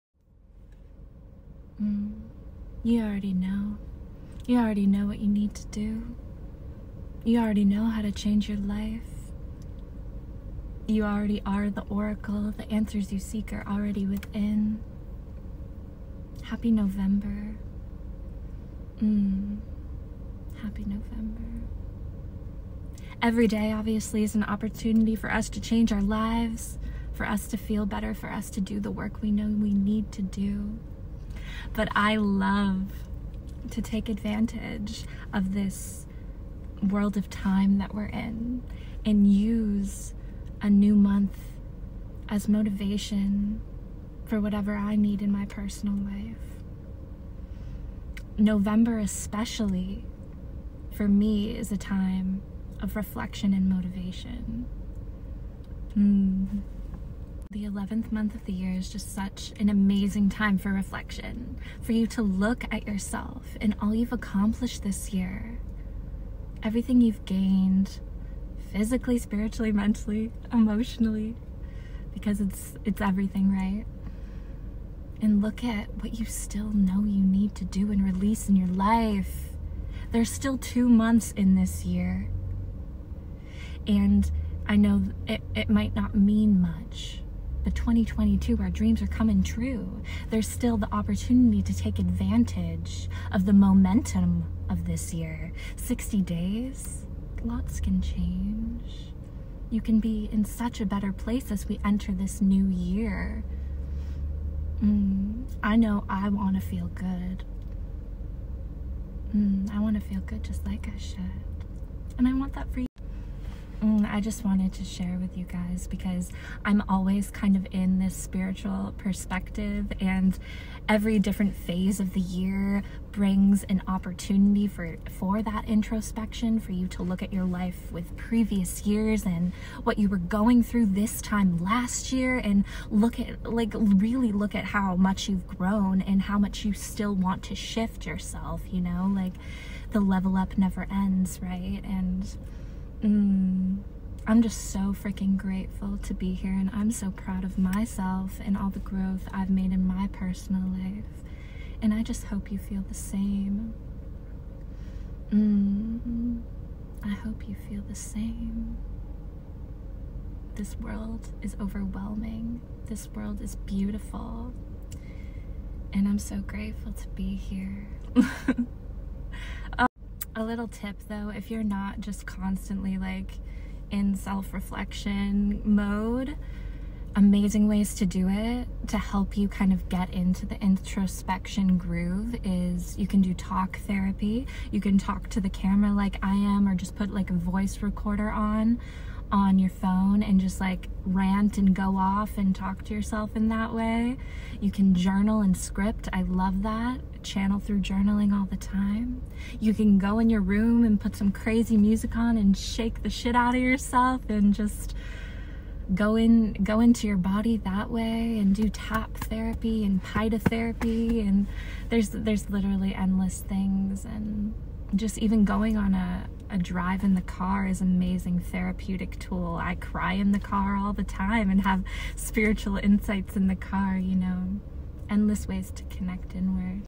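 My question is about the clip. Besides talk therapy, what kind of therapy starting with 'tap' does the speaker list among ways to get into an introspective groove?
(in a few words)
tap therapy.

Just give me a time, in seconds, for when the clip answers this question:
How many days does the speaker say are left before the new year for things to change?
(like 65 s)
95 s.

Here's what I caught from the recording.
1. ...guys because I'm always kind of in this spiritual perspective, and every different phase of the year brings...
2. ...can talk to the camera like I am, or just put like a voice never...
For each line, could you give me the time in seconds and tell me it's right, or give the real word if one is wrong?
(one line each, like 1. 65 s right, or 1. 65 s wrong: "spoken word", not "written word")
1. 115 s right
2. 184 s wrong: "recorder", not "never".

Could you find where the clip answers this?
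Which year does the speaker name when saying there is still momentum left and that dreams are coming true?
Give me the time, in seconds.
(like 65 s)
87 s.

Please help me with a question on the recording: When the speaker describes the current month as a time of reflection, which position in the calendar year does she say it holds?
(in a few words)
11th.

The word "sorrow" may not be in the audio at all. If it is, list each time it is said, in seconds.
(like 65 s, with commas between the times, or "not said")
not said.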